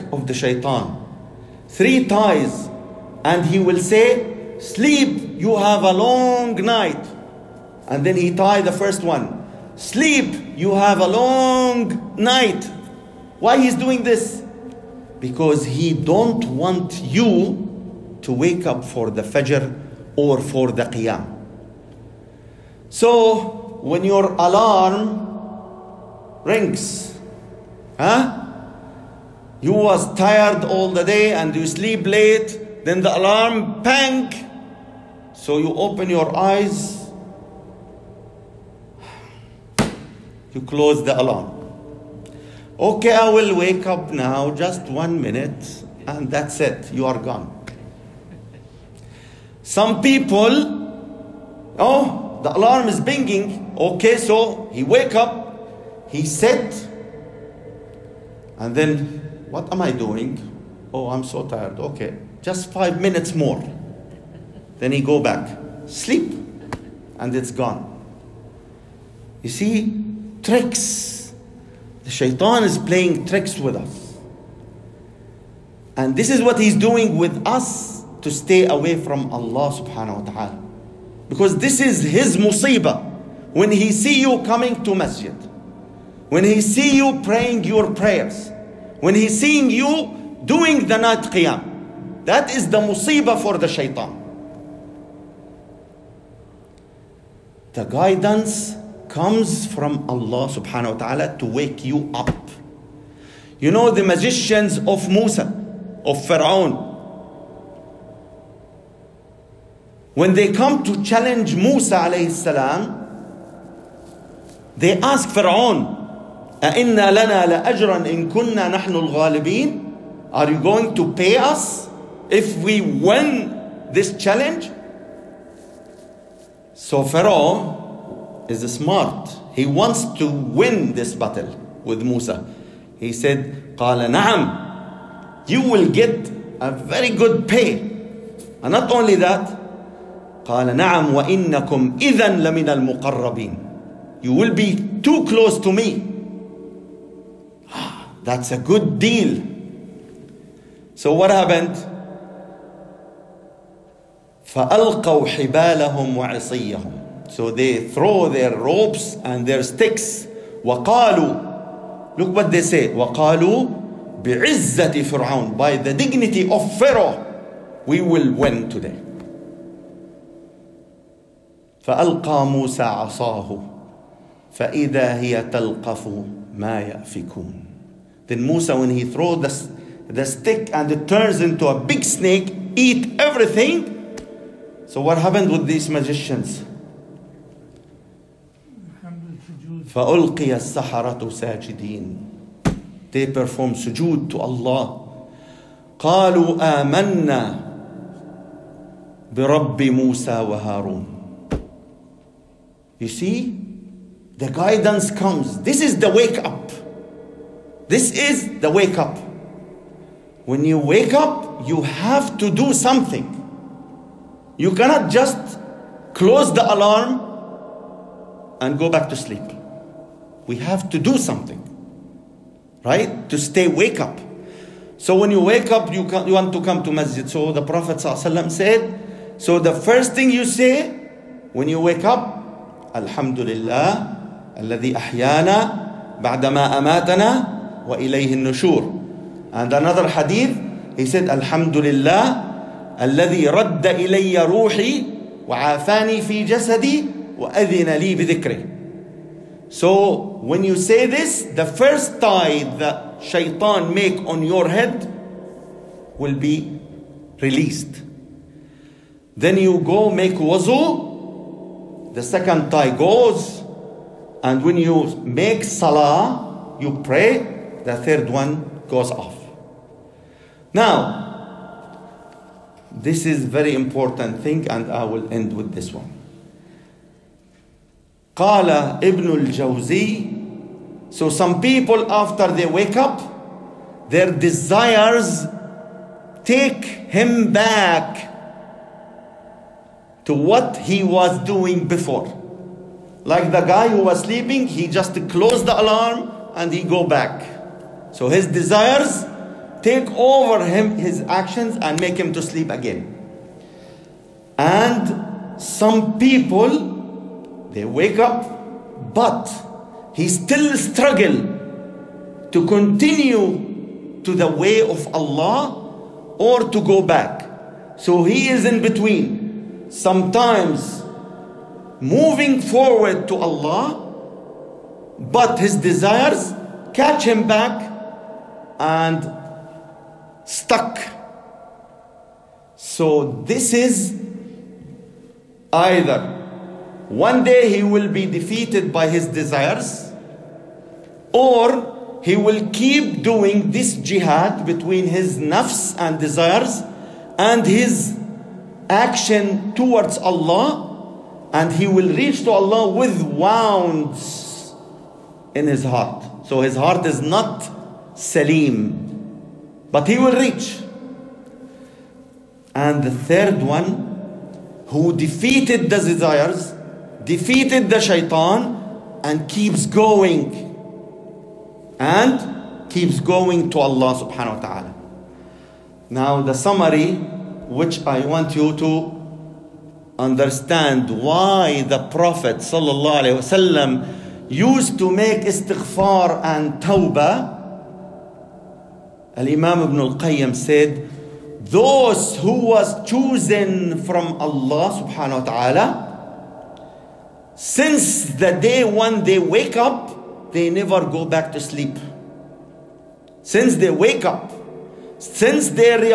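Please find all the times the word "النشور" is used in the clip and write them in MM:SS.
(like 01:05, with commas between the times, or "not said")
03:58.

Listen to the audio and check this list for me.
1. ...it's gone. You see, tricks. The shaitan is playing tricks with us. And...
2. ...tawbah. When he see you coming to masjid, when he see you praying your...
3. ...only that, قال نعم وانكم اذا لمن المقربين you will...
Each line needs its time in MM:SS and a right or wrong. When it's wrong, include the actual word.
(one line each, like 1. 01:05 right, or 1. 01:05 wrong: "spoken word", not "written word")
1. 01:07 right
2. 01:22 wrong: "musibah", not "tawbah"
3. 02:18 right.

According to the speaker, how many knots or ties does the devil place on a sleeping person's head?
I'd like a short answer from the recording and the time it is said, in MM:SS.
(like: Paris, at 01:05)
3, at 00:01.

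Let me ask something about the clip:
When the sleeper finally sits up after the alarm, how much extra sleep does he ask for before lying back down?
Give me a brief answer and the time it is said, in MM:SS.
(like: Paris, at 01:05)
5 minutes, at 01:02.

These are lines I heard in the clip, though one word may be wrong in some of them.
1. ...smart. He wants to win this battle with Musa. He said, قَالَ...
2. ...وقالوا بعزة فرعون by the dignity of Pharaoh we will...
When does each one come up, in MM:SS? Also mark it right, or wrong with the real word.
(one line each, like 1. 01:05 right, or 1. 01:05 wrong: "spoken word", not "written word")
1. 02:08 right
2. 02:42 right.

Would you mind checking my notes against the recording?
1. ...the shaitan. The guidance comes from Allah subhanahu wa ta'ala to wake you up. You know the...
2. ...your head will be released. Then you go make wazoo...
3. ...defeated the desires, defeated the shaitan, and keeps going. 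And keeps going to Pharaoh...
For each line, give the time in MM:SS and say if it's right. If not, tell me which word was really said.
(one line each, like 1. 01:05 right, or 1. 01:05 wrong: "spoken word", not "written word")
1. 01:33 right
2. 04:14 right
3. 06:05 wrong: "Allah", not "Pharaoh".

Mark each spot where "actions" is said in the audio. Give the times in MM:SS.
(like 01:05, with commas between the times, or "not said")
05:01, 05:48.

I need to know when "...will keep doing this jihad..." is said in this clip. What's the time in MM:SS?
05:42.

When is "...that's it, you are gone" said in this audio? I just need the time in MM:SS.
00:46.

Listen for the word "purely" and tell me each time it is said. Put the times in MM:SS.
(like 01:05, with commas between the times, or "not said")
not said.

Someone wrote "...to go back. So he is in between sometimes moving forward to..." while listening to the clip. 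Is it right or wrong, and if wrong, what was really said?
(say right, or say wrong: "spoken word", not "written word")
right.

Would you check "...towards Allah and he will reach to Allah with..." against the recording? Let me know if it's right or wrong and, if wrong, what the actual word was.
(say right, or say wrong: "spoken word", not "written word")
right.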